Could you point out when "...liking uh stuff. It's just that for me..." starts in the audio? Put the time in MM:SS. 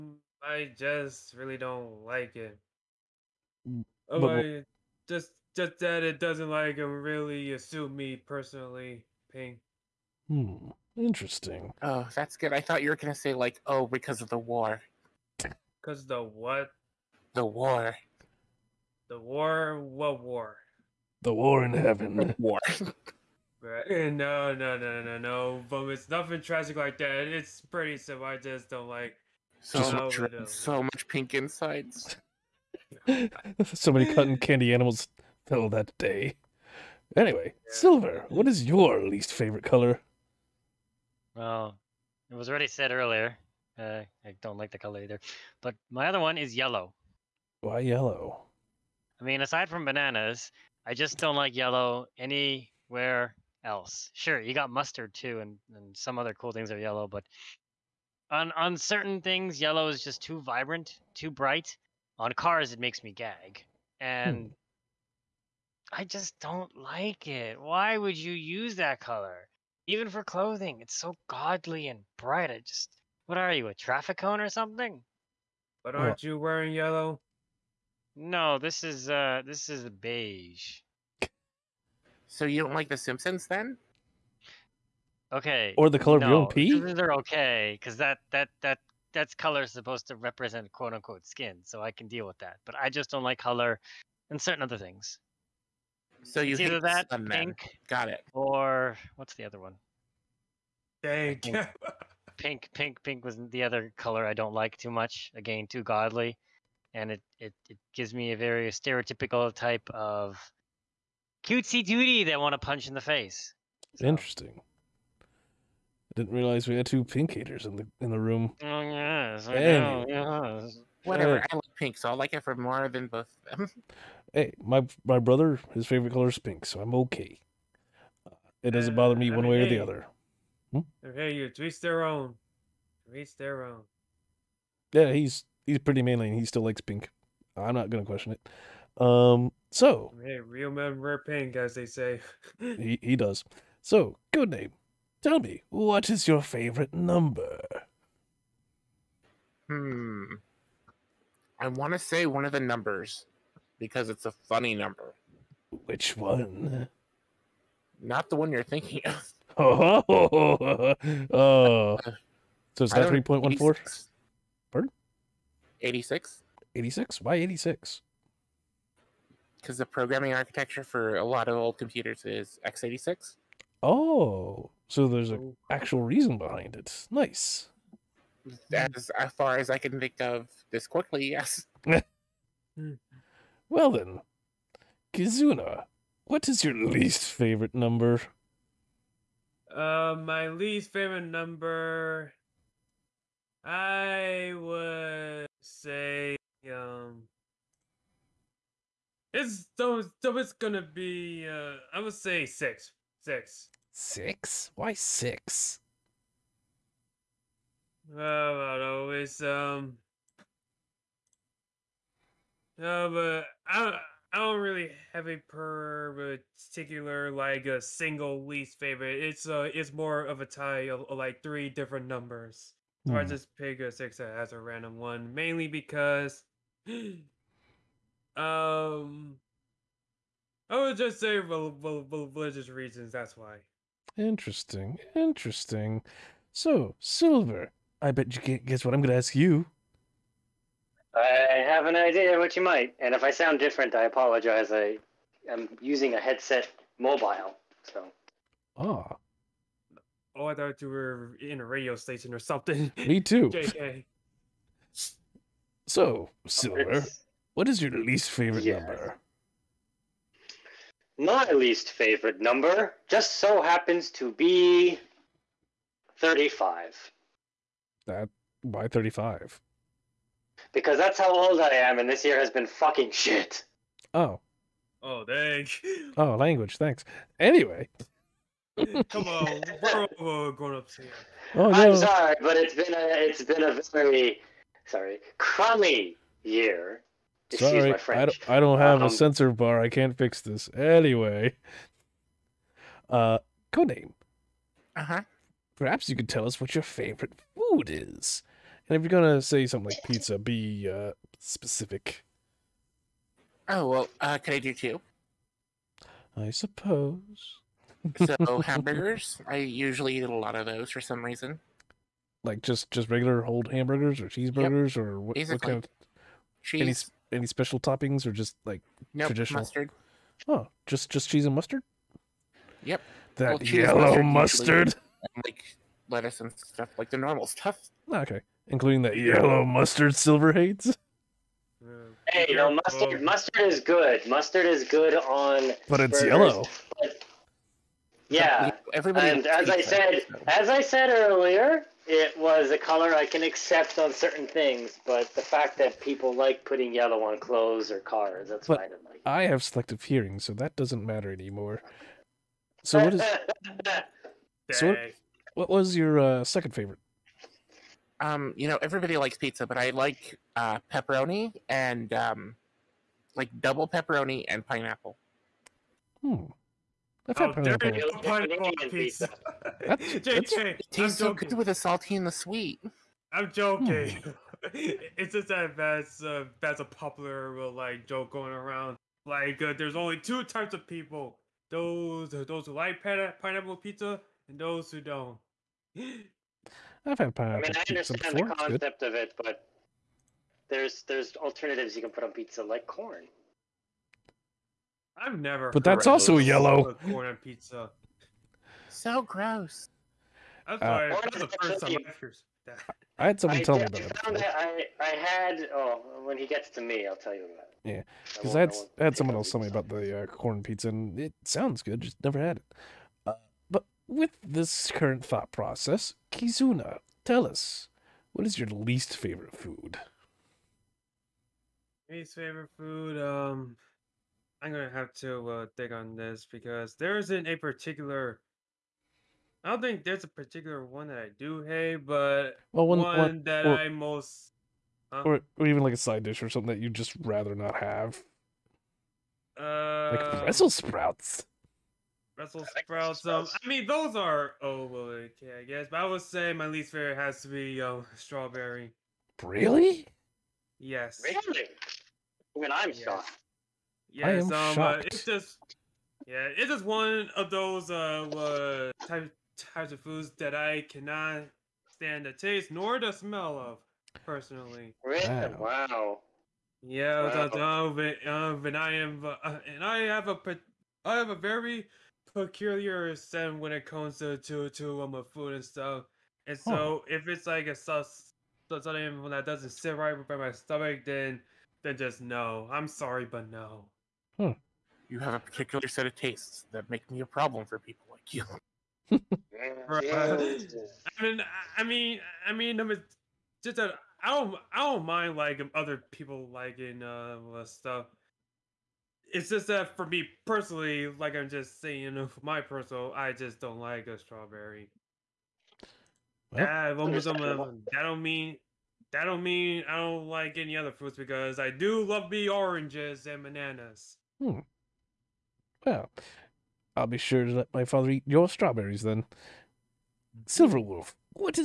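08:16.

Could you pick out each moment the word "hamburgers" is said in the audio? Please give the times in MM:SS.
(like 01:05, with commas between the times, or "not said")
05:08, 05:13.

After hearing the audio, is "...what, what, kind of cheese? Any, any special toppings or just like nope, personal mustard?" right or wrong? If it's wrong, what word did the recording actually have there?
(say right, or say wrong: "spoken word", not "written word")
wrong: "traditional", not "personal".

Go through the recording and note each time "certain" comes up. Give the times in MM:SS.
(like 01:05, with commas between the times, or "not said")
00:58, 01:34, 05:44.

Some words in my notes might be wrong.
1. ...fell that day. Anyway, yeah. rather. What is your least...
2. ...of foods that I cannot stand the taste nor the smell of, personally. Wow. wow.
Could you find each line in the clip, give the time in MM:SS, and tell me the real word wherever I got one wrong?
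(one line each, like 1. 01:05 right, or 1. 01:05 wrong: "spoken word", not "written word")
1. 00:35 wrong: "silver", not "rather"
2. 07:39 right.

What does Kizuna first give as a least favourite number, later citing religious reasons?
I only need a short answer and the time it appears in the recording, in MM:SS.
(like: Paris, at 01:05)
666, at 03:22.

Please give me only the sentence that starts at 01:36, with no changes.
So you it's either that pink, men.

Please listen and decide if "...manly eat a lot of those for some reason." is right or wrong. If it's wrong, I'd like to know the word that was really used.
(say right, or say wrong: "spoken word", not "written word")
wrong: "usually", not "manly".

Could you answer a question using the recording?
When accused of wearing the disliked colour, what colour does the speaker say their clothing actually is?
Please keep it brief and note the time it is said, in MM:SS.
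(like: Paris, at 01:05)
Beige, at 01:19.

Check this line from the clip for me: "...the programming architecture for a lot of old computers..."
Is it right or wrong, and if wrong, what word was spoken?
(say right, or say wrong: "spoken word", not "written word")
right.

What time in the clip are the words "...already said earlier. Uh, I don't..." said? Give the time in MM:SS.
00:42.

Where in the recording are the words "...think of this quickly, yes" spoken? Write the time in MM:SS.
02:59.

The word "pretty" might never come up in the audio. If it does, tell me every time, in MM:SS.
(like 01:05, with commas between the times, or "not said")
00:27, 02:15.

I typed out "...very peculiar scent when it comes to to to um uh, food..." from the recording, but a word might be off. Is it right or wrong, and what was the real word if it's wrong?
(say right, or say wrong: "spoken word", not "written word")
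right.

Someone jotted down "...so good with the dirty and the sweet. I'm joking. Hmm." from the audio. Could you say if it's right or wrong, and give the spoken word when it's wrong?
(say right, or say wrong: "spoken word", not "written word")
wrong: "salty", not "dirty".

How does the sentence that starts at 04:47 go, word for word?
sorry, my I don't, I don't have um, a censor bar.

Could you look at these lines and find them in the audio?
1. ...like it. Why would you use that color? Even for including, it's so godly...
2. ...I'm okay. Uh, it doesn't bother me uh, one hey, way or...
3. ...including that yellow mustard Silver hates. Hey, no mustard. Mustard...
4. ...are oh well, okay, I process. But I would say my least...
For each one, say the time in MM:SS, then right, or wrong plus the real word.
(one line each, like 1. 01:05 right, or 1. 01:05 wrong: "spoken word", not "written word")
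1. 01:06 wrong: "clothing", not "including"
2. 02:06 right
3. 05:28 right
4. 07:24 wrong: "guess", not "process".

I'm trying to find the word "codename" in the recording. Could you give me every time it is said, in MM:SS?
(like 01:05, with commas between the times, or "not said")
02:24, 04:53.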